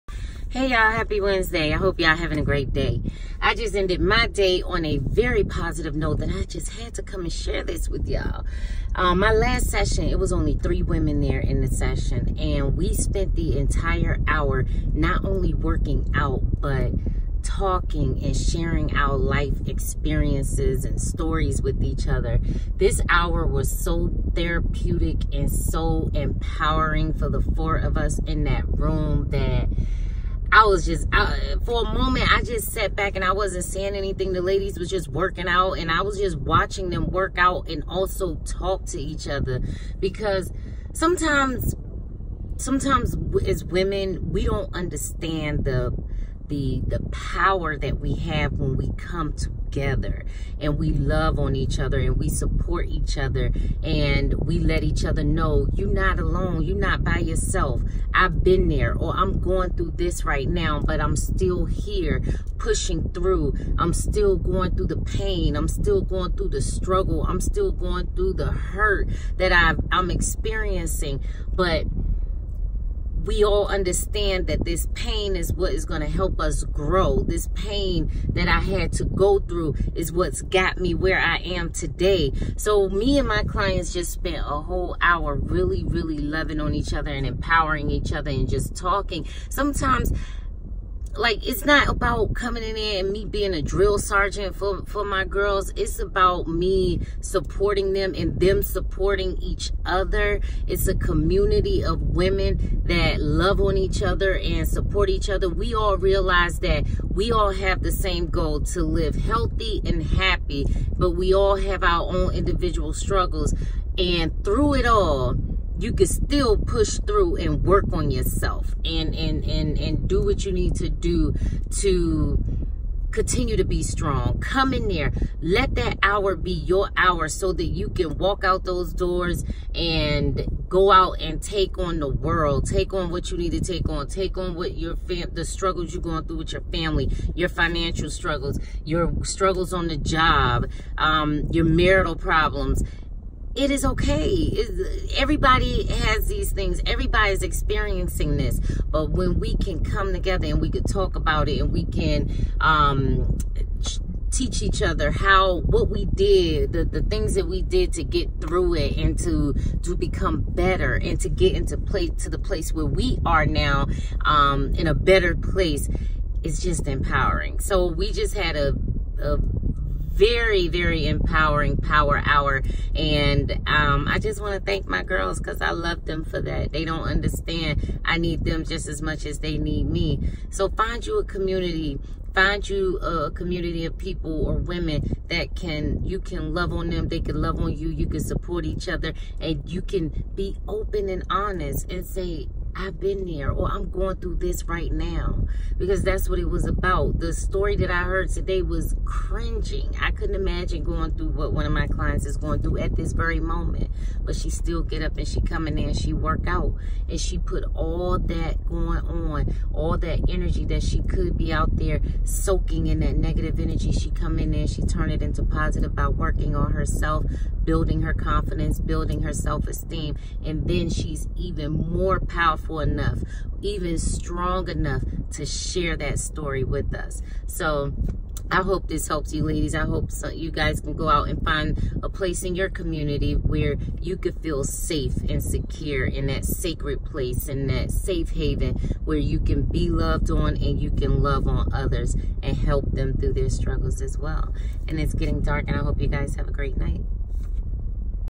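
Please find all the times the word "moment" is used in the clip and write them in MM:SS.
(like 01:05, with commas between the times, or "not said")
00:31, 03:23.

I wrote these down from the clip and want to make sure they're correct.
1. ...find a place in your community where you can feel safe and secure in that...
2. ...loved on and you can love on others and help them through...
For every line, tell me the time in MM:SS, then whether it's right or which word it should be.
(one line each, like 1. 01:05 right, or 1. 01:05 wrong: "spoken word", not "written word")
1. 03:51 right
2. 03:59 right.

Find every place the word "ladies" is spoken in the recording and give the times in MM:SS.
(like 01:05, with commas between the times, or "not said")
00:34, 03:49.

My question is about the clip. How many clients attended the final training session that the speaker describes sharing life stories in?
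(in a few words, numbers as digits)
3.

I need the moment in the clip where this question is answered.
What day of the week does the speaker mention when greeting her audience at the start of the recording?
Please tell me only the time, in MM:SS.
00:01.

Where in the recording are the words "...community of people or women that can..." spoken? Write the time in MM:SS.
03:03.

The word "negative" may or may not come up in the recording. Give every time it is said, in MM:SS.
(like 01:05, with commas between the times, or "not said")
03:33.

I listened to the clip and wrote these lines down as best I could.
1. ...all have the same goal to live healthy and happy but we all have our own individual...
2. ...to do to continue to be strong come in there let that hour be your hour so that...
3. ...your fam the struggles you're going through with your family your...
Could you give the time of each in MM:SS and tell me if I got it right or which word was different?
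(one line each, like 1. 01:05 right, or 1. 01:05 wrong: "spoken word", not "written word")
1. 01:47 right
2. 02:00 right
3. 02:14 right.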